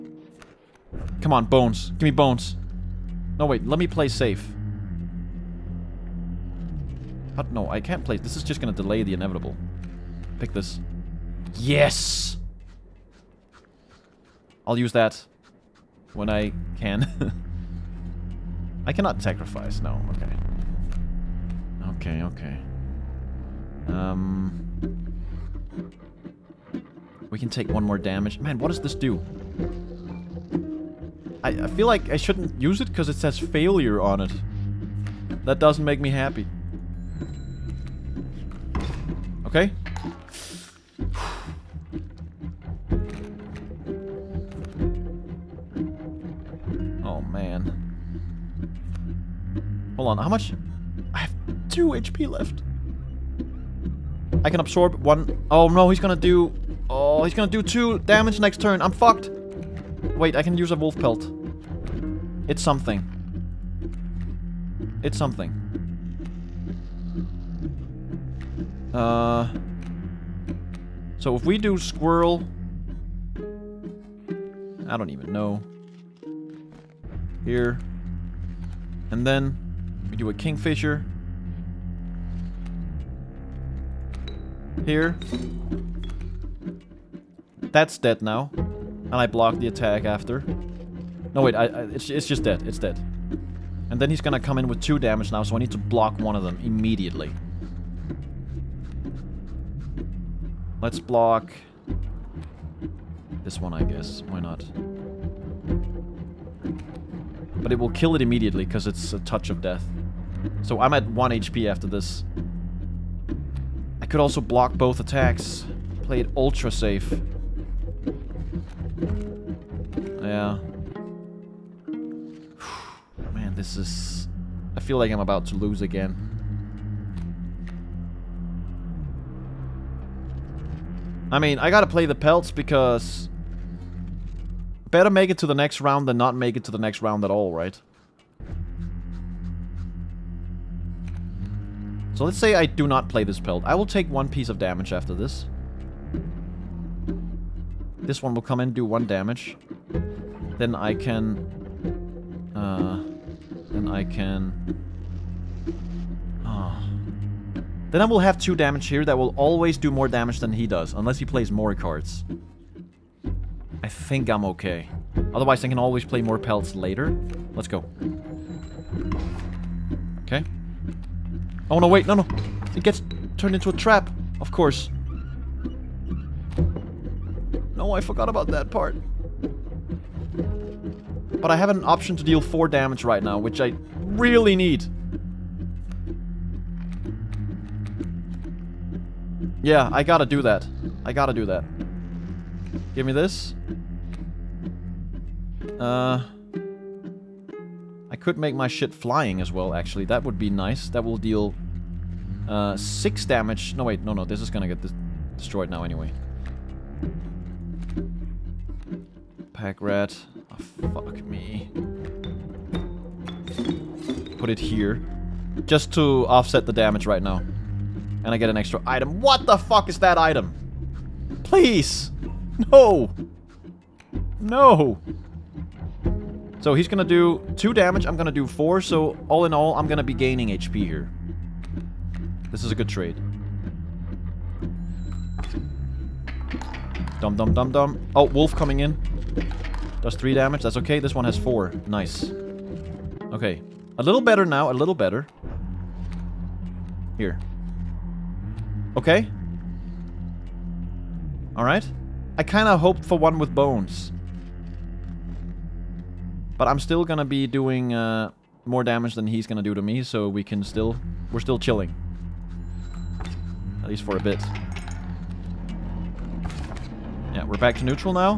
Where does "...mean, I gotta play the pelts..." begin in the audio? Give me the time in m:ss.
2:11.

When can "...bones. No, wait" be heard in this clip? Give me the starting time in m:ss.
0:02.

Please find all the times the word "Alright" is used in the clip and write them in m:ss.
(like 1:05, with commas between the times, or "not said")
4:11.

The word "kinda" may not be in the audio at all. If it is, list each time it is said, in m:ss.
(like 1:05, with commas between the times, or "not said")
4:12.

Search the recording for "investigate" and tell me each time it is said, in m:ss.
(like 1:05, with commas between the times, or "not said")
not said.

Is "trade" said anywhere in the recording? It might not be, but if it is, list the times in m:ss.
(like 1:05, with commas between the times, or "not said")
3:52.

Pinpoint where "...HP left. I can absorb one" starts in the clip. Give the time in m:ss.
0:51.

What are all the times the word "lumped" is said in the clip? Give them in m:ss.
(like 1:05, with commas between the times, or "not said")
not said.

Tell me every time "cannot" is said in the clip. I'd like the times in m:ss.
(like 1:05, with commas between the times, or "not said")
0:18.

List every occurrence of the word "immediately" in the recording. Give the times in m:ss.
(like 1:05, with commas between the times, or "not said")
1:36, 1:48.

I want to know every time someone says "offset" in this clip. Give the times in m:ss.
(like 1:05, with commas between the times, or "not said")
3:36.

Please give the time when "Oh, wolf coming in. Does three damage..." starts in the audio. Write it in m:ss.
3:58.